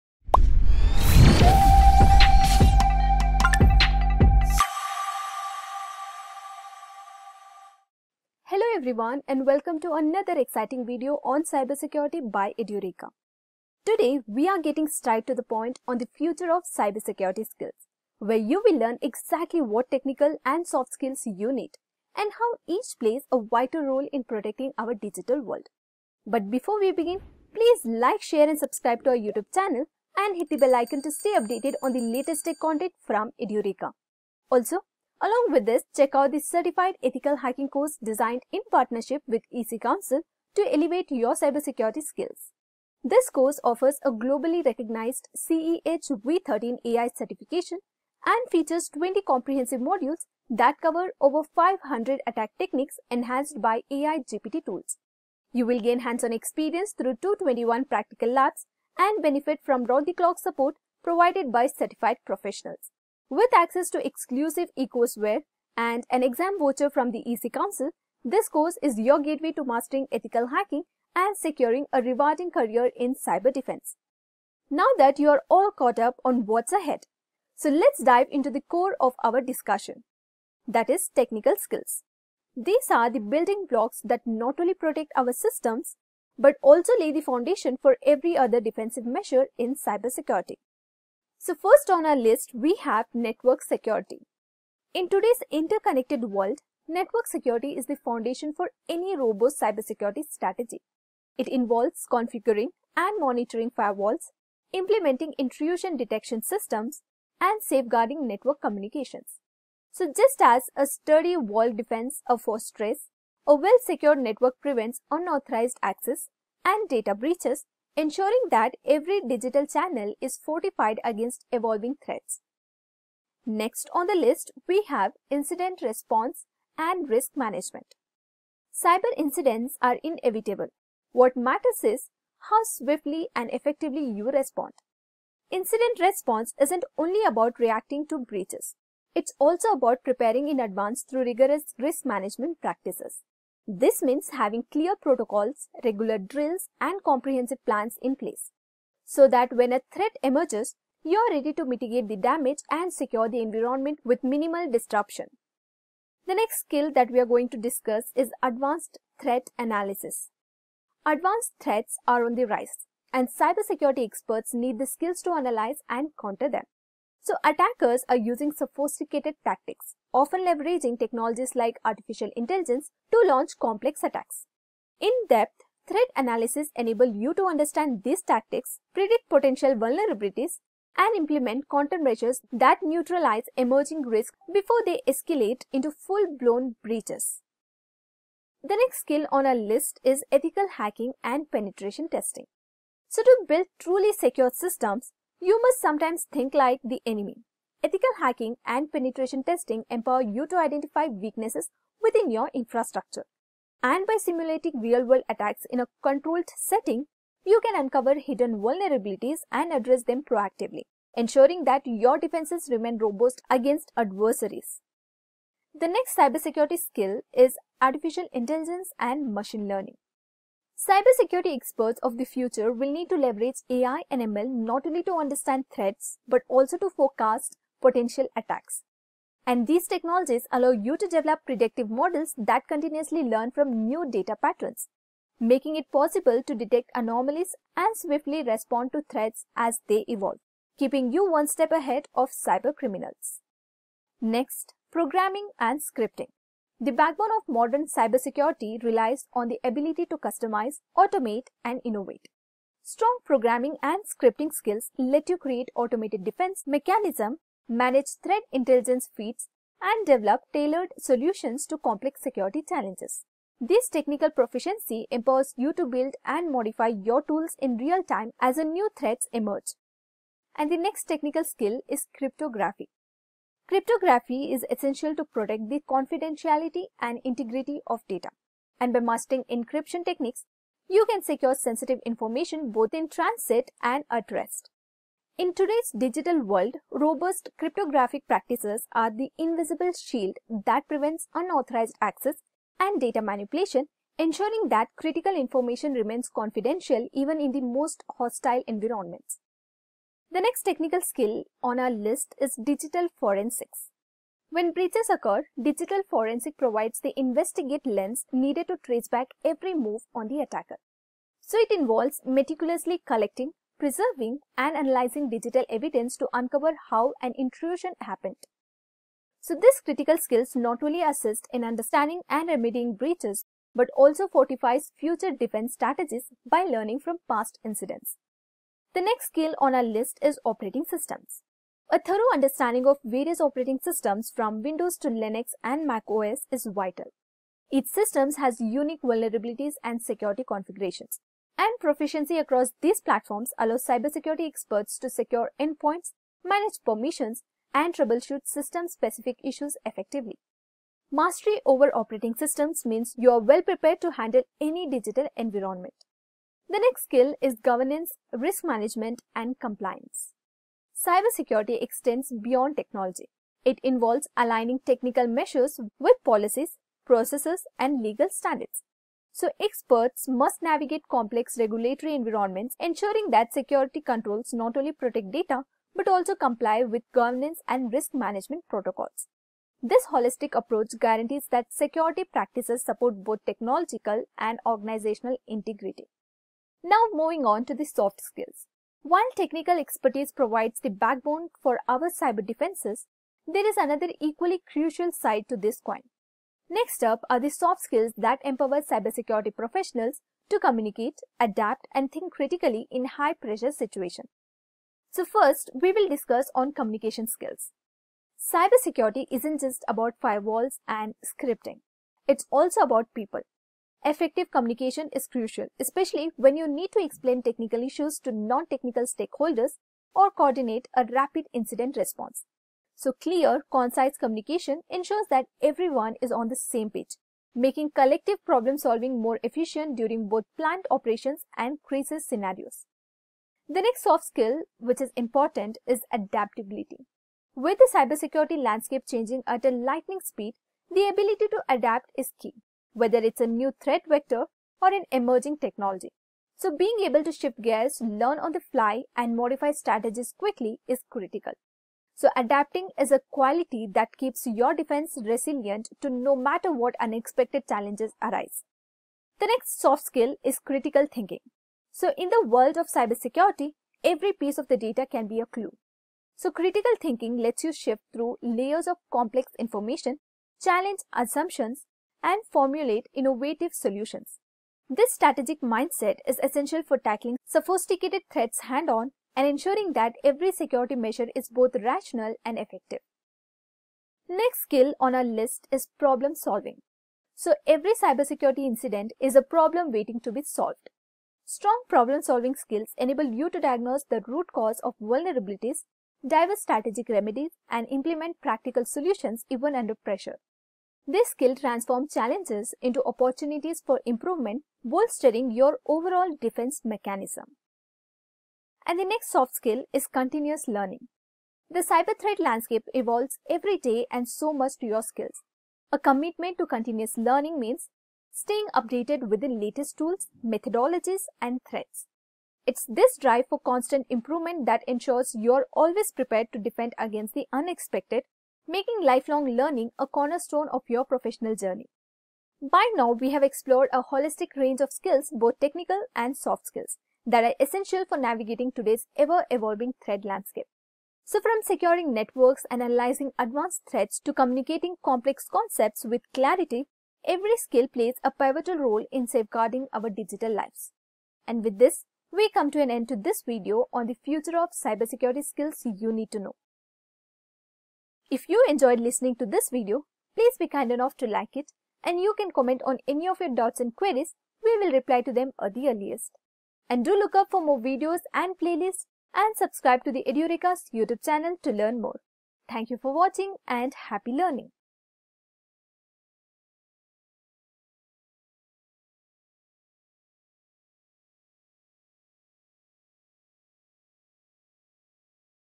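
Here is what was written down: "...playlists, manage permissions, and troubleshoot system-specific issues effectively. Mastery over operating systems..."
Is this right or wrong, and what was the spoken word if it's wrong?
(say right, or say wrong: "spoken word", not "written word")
wrong: "endpoints", not "playlists".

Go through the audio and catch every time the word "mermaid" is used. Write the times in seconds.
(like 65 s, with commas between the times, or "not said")
not said.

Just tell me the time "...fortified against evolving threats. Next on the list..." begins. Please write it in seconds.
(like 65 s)
120 s.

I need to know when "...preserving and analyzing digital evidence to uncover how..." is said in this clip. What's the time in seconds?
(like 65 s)
313 s.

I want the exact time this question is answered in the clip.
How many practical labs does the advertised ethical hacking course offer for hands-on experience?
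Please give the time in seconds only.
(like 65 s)
57 s.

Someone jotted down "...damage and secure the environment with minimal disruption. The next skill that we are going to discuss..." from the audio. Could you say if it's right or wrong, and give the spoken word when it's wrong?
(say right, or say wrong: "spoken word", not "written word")
right.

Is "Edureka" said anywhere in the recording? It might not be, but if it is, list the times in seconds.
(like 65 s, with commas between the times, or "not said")
12 s, 33 s, 570 s.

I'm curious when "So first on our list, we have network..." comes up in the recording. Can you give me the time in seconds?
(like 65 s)
91 s.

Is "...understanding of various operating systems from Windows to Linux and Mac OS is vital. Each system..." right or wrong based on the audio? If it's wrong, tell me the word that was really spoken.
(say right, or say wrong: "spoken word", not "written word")
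right.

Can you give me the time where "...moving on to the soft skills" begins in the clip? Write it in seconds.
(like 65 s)
387 s.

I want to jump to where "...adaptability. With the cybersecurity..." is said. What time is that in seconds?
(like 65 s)
436 s.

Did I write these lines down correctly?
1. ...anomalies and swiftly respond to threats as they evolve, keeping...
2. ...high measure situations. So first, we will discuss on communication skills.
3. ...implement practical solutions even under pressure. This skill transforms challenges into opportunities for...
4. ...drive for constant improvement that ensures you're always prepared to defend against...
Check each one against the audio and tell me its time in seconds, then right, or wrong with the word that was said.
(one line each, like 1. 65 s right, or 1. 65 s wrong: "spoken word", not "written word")
1. 236 s right
2. 403 s wrong: "pressure", not "measure"
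3. 497 s right
4. 523 s right.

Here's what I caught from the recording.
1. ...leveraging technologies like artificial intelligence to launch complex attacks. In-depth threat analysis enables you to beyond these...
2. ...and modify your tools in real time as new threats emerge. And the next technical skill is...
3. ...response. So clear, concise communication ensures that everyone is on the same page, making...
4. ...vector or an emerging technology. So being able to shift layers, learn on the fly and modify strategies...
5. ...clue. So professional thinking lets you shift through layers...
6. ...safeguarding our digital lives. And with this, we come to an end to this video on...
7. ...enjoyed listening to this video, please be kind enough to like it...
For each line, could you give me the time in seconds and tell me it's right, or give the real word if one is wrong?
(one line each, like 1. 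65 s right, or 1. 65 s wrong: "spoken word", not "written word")
1. 170 s wrong: "understand", not "beyond"
2. 266 s right
3. 421 s right
4. 444 s wrong: "gears", not "layers"
5. 465 s wrong: "critical", not "professional"
6. 549 s right
7. 558 s right.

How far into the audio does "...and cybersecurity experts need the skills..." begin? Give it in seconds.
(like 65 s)
163 s.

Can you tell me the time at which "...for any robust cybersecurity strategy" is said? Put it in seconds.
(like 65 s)
98 s.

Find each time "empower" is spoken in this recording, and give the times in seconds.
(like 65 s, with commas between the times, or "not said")
199 s, 265 s, 398 s.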